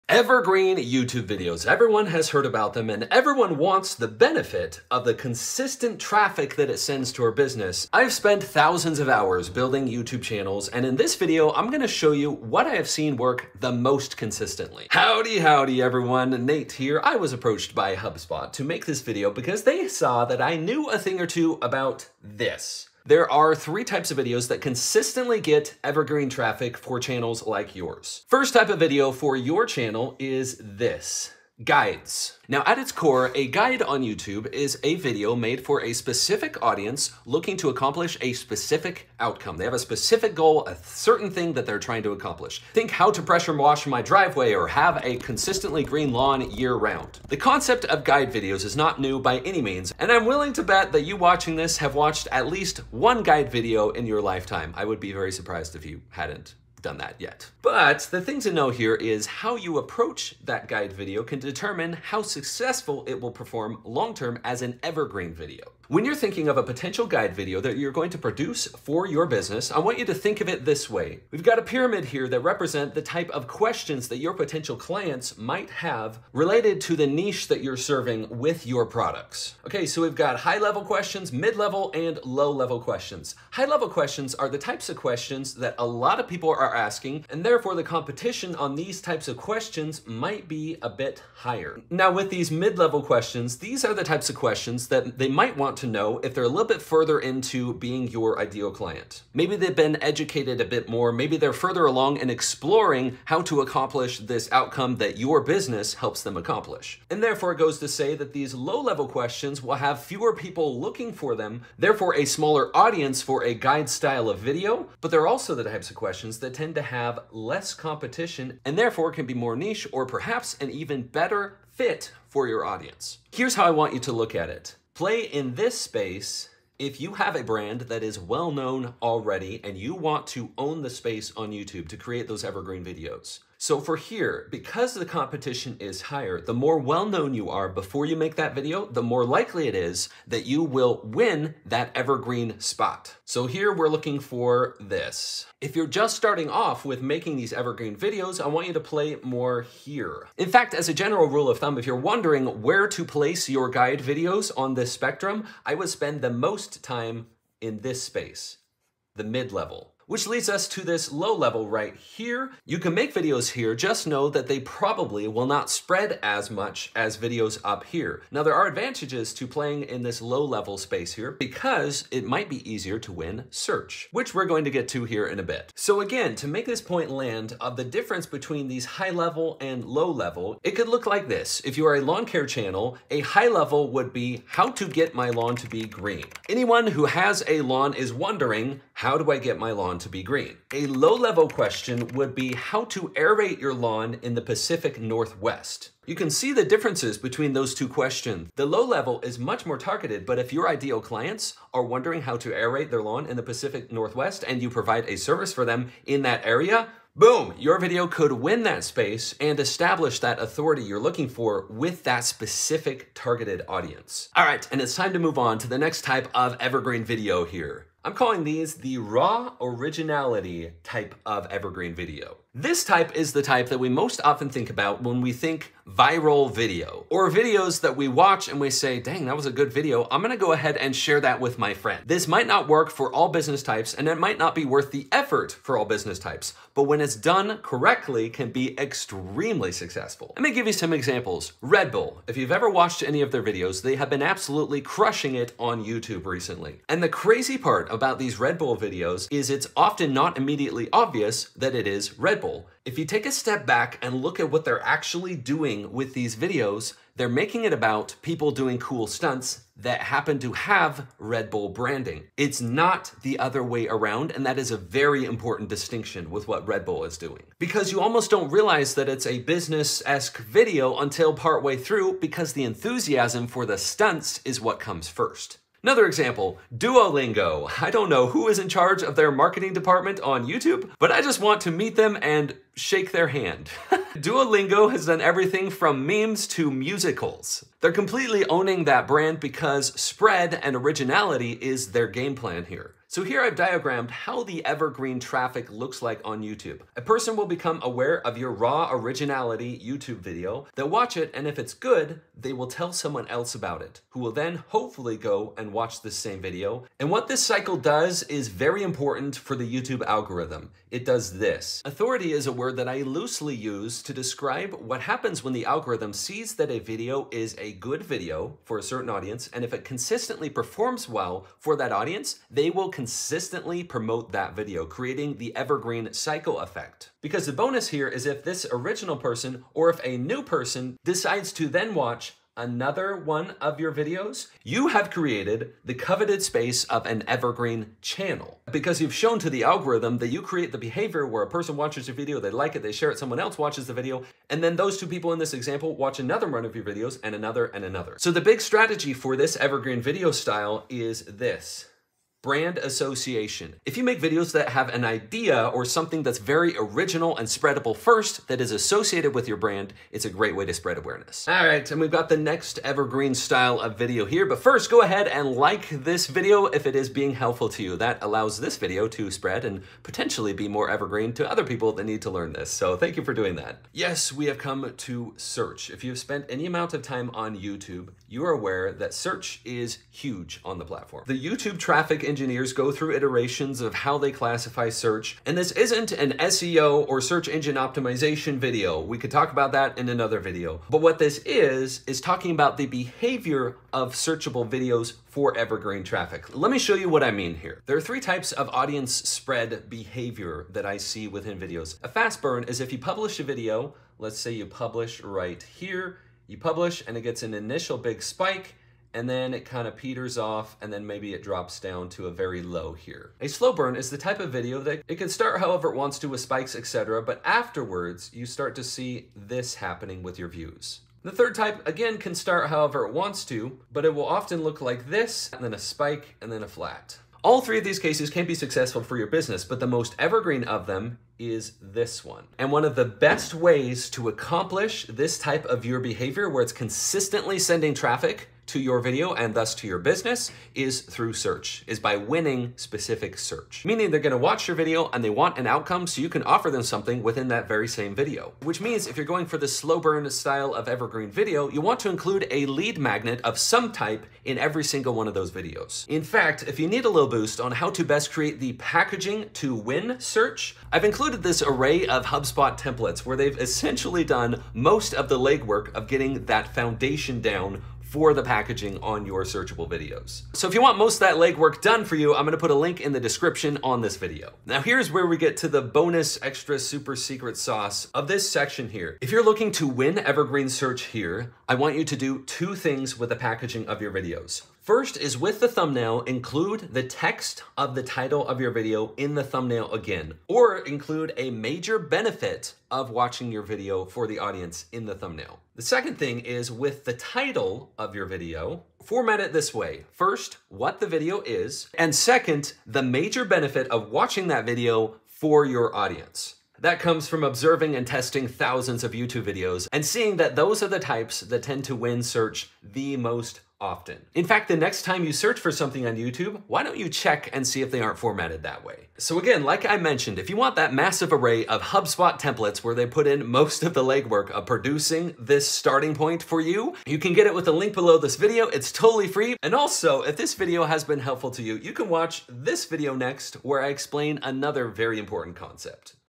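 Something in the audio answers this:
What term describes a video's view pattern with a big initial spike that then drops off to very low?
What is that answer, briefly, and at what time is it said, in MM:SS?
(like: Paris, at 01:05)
fast burn, at 06:42.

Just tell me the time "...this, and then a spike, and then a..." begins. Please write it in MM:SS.
07:05.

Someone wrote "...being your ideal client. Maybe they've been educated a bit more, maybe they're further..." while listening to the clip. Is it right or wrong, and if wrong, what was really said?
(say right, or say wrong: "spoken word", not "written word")
right.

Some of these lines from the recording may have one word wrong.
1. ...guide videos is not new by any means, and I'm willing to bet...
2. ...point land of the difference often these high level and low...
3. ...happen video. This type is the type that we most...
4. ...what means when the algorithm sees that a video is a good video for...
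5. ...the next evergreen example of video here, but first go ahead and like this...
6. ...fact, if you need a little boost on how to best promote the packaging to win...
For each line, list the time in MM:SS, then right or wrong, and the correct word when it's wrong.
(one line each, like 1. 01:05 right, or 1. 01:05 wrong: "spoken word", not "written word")
1. 00:48 right
2. 02:56 wrong: "between", not "often"
3. 03:41 wrong: "evergreen", not "happen"
4. 05:14 wrong: "happens", not "means"
5. 06:02 wrong: "style", not "example"
6. 07:36 wrong: "create", not "promote".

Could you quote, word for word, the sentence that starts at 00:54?
I would be very surprised if you hadn't done that yet.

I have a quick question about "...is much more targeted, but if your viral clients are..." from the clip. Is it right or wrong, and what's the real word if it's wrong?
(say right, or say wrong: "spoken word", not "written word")
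wrong: "ideal", not "viral".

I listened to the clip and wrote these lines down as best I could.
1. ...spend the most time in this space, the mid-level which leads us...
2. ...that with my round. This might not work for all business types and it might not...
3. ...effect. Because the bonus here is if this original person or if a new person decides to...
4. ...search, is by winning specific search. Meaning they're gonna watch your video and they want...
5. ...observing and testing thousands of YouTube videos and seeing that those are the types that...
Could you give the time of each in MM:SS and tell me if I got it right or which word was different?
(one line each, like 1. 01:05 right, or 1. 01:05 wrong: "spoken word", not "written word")
1. 02:35 right
2. 03:51 wrong: "friend", not "round"
3. 05:26 right
4. 07:21 right
5. 08:27 right.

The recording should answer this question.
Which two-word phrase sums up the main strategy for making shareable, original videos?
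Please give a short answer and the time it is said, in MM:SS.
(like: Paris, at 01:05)
Brand association, at 05:52.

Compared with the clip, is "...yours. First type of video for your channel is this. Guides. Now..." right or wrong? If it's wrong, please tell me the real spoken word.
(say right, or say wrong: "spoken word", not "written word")
right.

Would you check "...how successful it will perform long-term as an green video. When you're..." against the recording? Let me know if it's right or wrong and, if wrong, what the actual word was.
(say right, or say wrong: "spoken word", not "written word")
wrong: "evergreen", not "green".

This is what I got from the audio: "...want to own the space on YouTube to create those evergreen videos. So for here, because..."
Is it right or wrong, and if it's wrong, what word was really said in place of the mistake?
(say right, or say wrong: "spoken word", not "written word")
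right.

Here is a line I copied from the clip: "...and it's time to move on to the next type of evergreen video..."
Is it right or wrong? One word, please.
right.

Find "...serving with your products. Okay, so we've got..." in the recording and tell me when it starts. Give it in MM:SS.
01:17.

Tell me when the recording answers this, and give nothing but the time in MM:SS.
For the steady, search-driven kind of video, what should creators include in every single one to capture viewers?
07:32.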